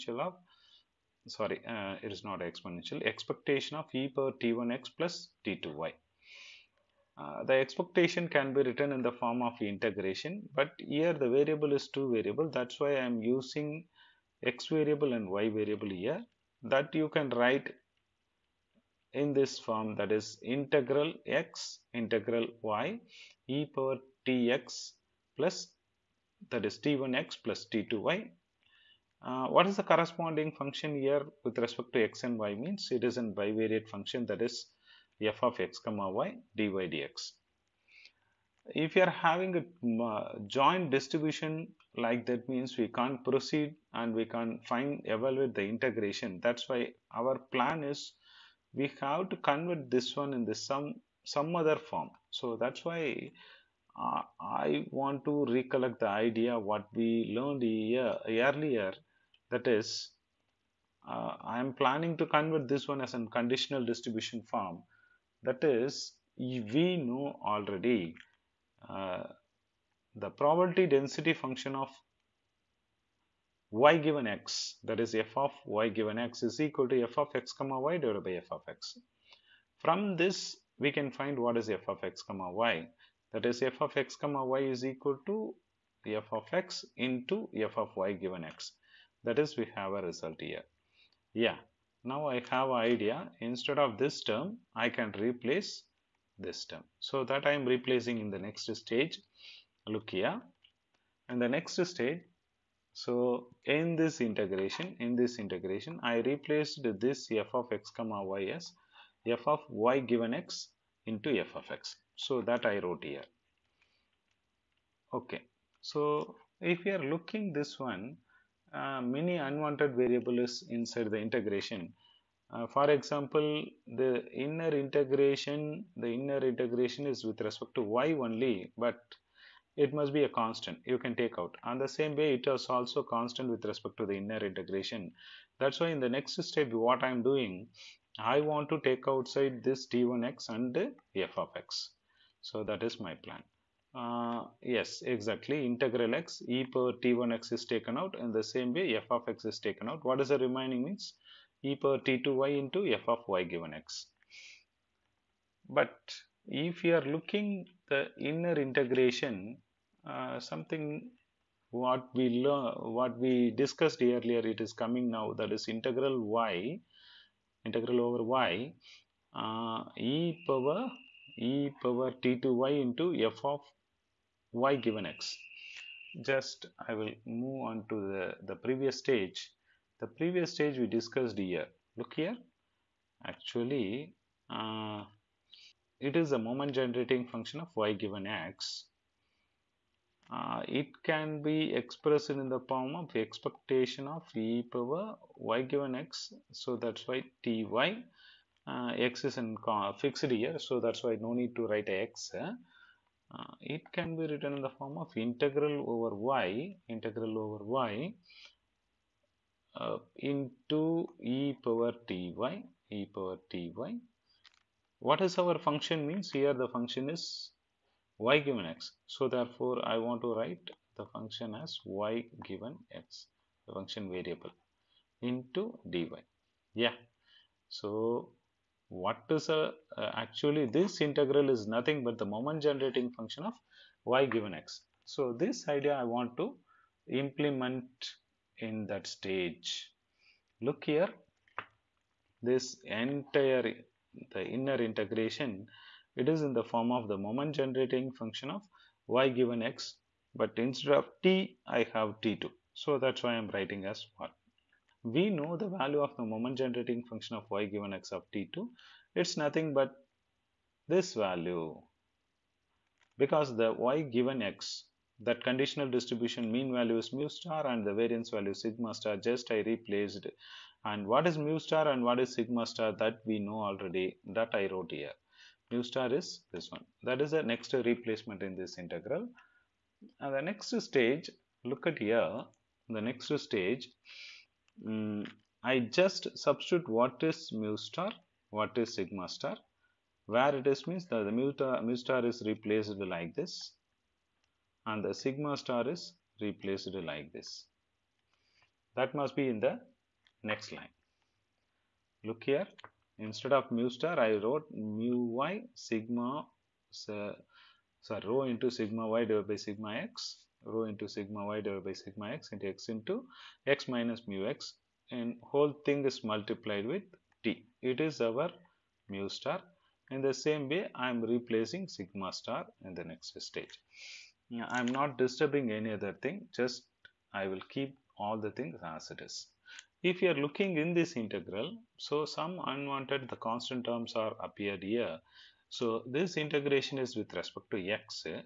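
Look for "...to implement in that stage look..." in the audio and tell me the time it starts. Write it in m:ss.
3:56.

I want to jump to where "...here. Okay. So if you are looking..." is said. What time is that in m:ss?
1:53.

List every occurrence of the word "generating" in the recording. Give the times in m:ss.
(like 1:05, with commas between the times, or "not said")
3:06, 3:52, 4:07, 4:16.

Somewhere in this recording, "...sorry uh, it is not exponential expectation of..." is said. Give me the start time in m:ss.
0:01.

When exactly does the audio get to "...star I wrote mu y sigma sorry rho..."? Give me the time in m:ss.
5:03.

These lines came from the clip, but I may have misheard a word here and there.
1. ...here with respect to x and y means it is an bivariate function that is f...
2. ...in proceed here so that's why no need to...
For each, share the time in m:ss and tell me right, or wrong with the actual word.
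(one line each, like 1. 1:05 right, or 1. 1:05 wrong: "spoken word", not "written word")
1. 0:30 right
2. 3:19 wrong: "fixed", not "proceed".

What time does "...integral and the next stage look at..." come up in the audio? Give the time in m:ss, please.
4:38.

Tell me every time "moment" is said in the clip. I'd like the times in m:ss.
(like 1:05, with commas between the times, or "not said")
3:06, 3:52, 4:07, 4:16.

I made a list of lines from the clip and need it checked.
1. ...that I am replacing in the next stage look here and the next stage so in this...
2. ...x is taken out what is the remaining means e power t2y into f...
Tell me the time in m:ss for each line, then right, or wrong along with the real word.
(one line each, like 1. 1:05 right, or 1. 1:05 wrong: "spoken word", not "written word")
1. 1:37 right
2. 2:29 right.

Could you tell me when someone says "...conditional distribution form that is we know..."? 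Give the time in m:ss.
1:03.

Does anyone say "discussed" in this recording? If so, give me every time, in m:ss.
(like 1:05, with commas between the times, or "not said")
2:43, 3:00.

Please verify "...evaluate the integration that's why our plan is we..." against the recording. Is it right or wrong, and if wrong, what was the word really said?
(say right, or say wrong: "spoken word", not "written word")
right.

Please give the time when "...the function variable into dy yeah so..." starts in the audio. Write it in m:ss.
3:43.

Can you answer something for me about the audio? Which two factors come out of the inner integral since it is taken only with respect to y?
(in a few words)
e power t1x and f of x.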